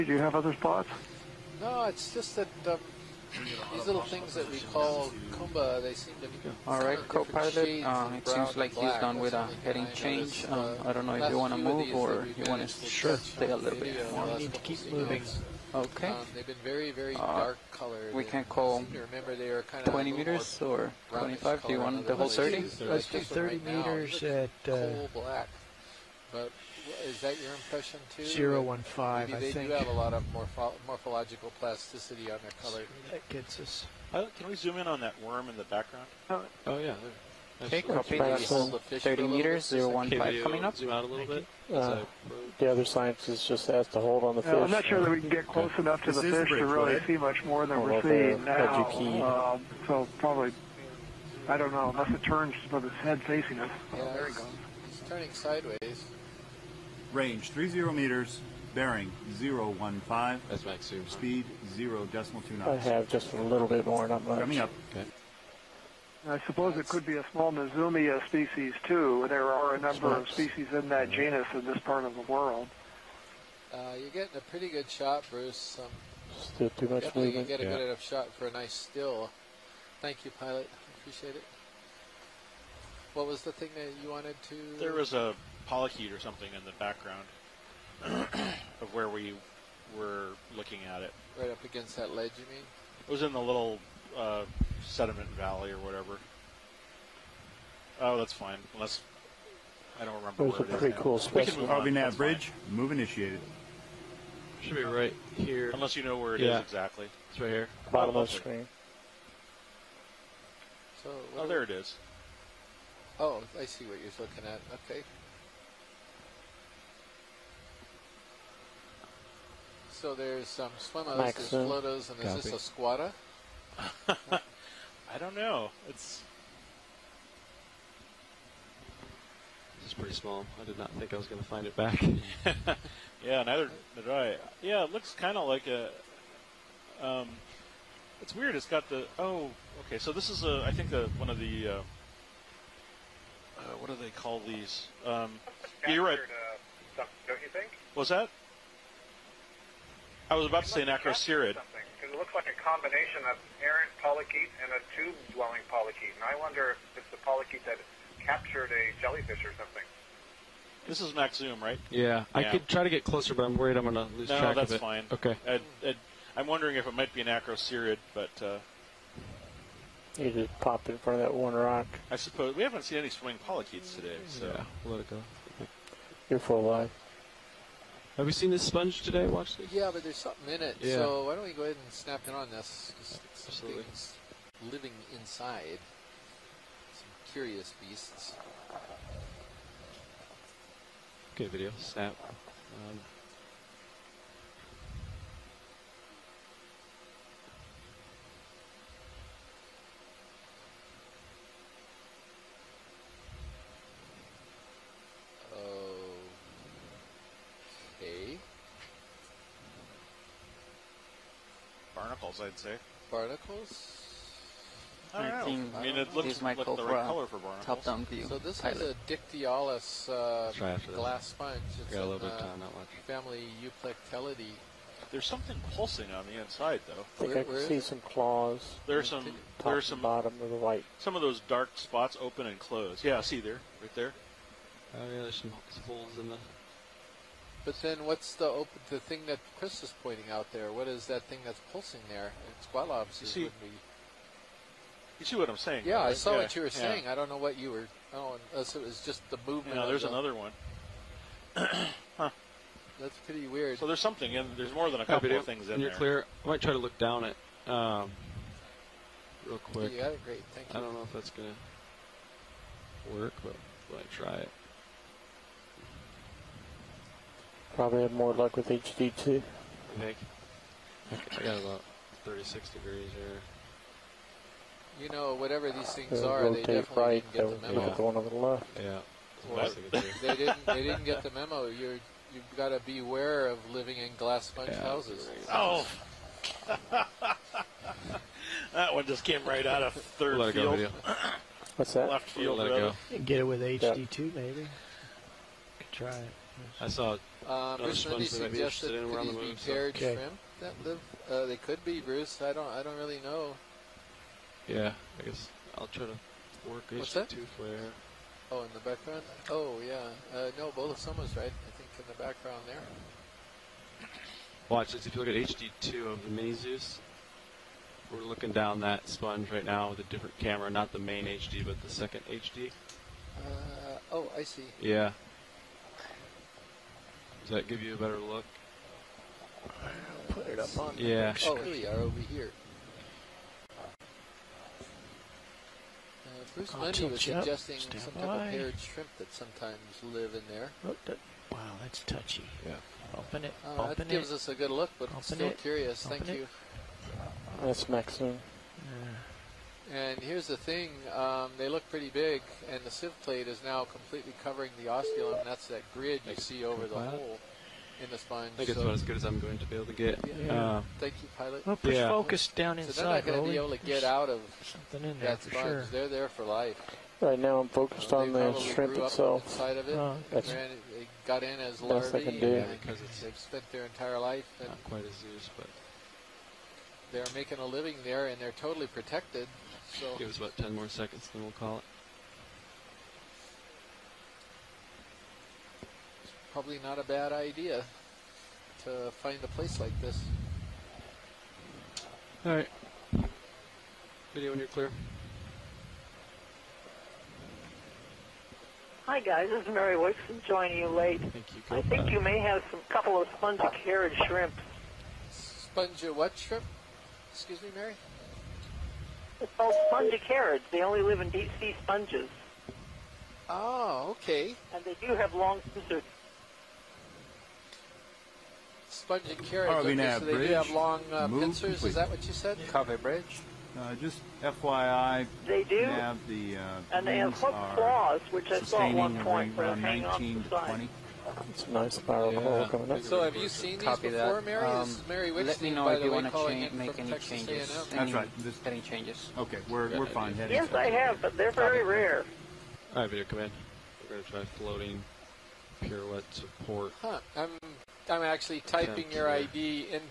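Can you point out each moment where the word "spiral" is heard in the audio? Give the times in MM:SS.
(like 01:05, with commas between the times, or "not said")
07:11.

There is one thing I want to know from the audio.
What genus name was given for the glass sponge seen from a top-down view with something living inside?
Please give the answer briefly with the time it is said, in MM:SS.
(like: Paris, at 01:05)
Dictyaulus, at 03:39.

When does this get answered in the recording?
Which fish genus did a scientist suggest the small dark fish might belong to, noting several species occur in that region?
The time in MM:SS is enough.
01:07.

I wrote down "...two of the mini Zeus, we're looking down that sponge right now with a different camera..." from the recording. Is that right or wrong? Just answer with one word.
right.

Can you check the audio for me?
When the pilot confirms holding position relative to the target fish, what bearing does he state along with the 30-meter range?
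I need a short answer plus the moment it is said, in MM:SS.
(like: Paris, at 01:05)
015, at 00:58.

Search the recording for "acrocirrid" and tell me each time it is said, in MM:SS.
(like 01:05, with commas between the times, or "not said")
02:30, 02:47.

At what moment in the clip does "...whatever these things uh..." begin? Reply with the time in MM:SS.
04:35.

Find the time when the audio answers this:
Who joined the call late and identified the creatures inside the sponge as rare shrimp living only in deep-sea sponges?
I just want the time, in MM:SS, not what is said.
06:39.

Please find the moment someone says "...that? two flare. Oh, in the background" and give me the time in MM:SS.
05:07.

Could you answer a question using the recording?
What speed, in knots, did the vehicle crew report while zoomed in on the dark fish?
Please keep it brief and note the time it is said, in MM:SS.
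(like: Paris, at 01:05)
0.2 knots, at 01:01.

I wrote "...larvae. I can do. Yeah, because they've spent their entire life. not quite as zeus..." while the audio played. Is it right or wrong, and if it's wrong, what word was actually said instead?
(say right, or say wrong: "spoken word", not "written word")
right.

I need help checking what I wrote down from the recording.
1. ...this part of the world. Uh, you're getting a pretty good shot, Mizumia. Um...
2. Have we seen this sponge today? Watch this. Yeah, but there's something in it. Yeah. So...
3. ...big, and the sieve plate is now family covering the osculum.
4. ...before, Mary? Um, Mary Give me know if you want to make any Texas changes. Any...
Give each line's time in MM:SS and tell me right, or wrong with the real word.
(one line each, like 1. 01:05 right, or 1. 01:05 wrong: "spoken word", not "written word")
1. 01:11 wrong: "Bruce", not "Mizumia"
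2. 02:58 right
3. 05:52 wrong: "completely", not "family"
4. 07:14 wrong: "Let", not "Give".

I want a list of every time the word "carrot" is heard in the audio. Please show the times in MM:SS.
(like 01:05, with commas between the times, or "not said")
06:43, 06:59.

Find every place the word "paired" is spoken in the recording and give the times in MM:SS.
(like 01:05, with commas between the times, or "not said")
04:59, 05:38.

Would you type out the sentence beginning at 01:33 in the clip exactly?
It was in the little uh, Sediment Valley or whatever.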